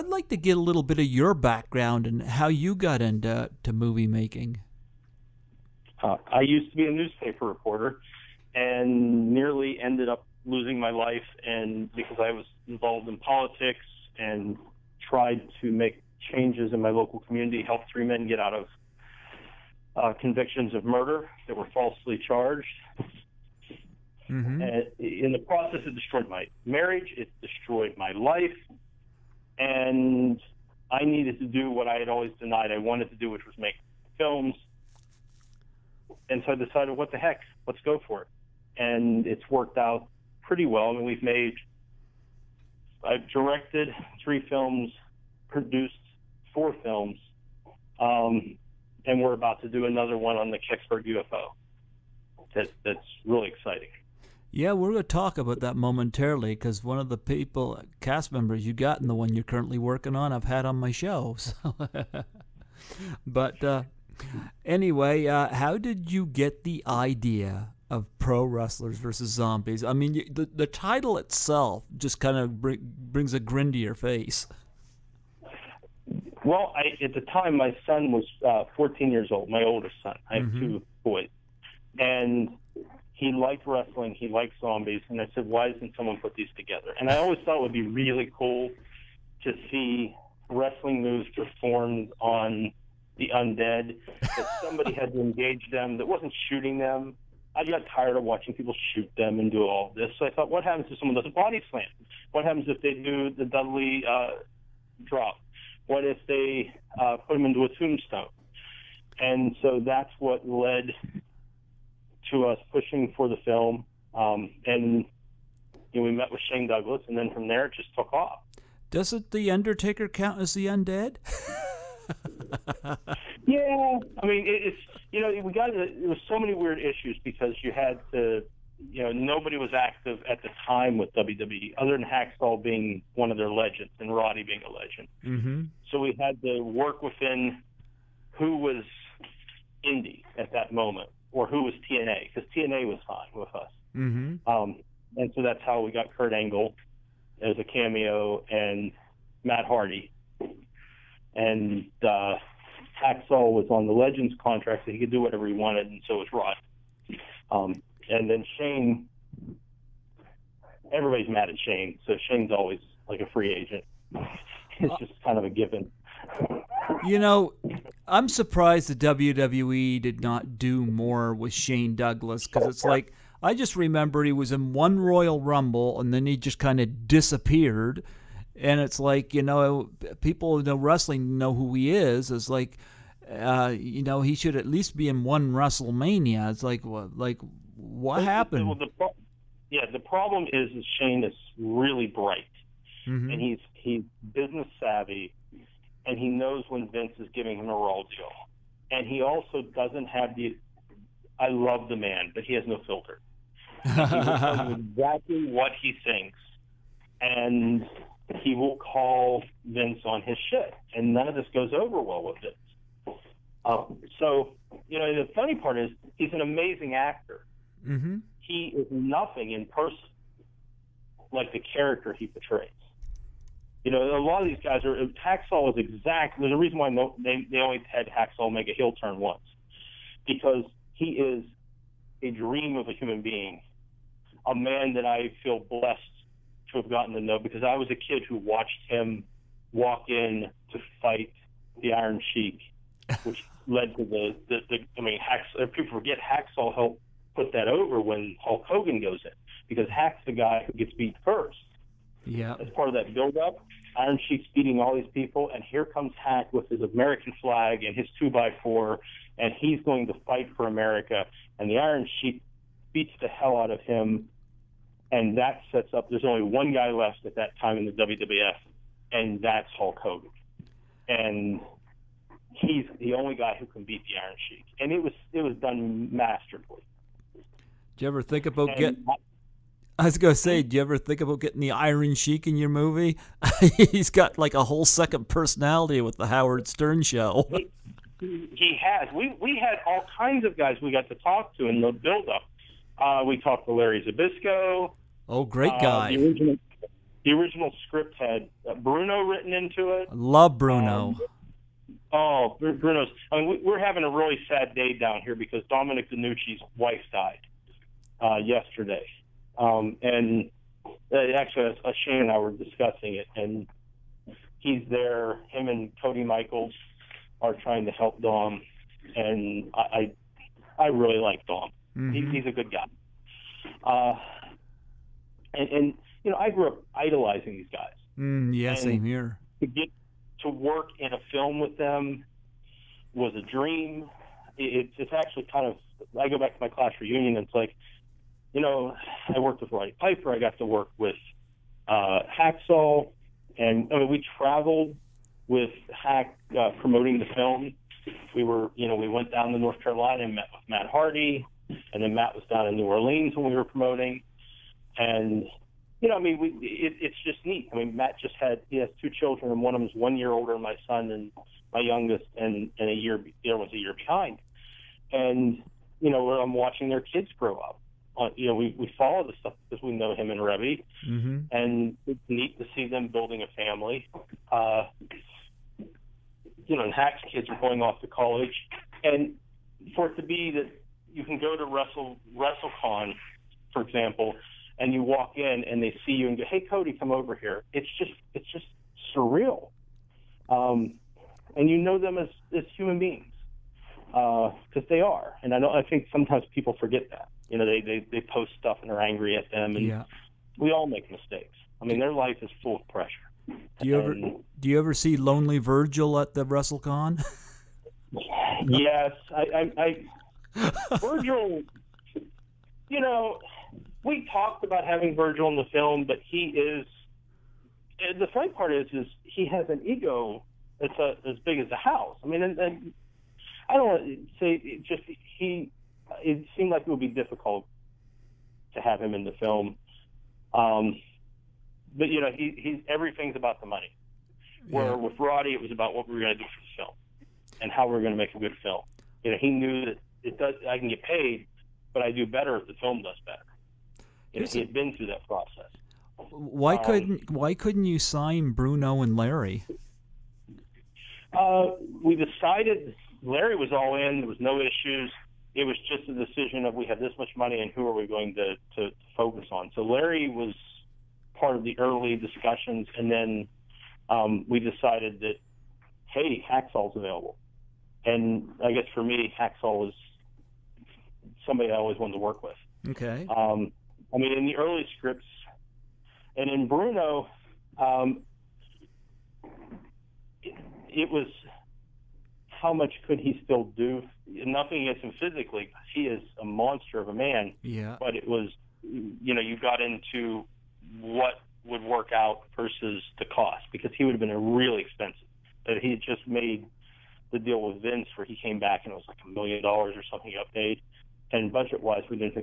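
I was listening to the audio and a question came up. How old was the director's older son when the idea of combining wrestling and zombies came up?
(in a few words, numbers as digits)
14.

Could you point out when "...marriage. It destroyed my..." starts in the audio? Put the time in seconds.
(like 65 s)
26 s.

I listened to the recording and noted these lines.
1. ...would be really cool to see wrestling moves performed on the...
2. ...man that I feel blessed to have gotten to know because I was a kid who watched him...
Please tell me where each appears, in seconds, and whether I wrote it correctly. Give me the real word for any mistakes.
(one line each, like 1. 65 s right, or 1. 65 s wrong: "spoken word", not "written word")
1. 87 s right
2. 234 s right.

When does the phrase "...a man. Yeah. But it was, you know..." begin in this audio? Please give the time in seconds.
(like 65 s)
487 s.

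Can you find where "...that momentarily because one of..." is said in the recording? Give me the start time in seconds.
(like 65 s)
55 s.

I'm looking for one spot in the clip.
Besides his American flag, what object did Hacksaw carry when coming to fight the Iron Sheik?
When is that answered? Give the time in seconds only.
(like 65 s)
258 s.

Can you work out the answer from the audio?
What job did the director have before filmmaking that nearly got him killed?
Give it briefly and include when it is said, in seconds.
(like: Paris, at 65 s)
Newspaper reporter, at 6 s.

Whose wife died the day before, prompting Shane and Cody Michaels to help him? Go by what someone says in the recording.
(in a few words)
Dominic DeNucci.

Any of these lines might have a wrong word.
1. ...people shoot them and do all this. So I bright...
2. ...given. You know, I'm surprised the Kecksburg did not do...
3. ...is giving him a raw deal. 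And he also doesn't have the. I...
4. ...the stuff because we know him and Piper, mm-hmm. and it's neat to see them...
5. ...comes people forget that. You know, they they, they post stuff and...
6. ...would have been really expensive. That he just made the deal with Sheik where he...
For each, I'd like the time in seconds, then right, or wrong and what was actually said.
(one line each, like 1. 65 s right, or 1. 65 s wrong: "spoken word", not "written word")
1. 98 s wrong: "thought", not "bright"
2. 165 s wrong: "WWE", not "Kecksburg"
3. 197 s right
4. 369 s wrong: "Reby", not "Piper"
5. 396 s wrong: "sometimes", not "comes"
6. 494 s wrong: "Vince", not "Sheik".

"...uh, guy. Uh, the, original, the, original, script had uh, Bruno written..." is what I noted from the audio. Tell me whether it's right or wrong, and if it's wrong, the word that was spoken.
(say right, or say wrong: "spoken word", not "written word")
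right.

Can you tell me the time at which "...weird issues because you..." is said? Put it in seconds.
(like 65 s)
126 s.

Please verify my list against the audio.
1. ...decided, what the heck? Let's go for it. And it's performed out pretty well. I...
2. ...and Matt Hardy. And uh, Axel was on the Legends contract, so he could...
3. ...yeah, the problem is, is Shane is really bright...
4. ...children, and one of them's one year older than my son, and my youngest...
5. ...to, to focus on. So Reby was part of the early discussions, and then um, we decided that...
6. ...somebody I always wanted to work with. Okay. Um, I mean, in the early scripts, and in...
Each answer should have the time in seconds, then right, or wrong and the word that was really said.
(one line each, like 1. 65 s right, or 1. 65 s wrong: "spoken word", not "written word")
1. 36 s wrong: "worked", not "performed"
2. 148 s right
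3. 189 s right
4. 359 s right
5. 458 s wrong: "Larry", not "Reby"
6. 471 s right.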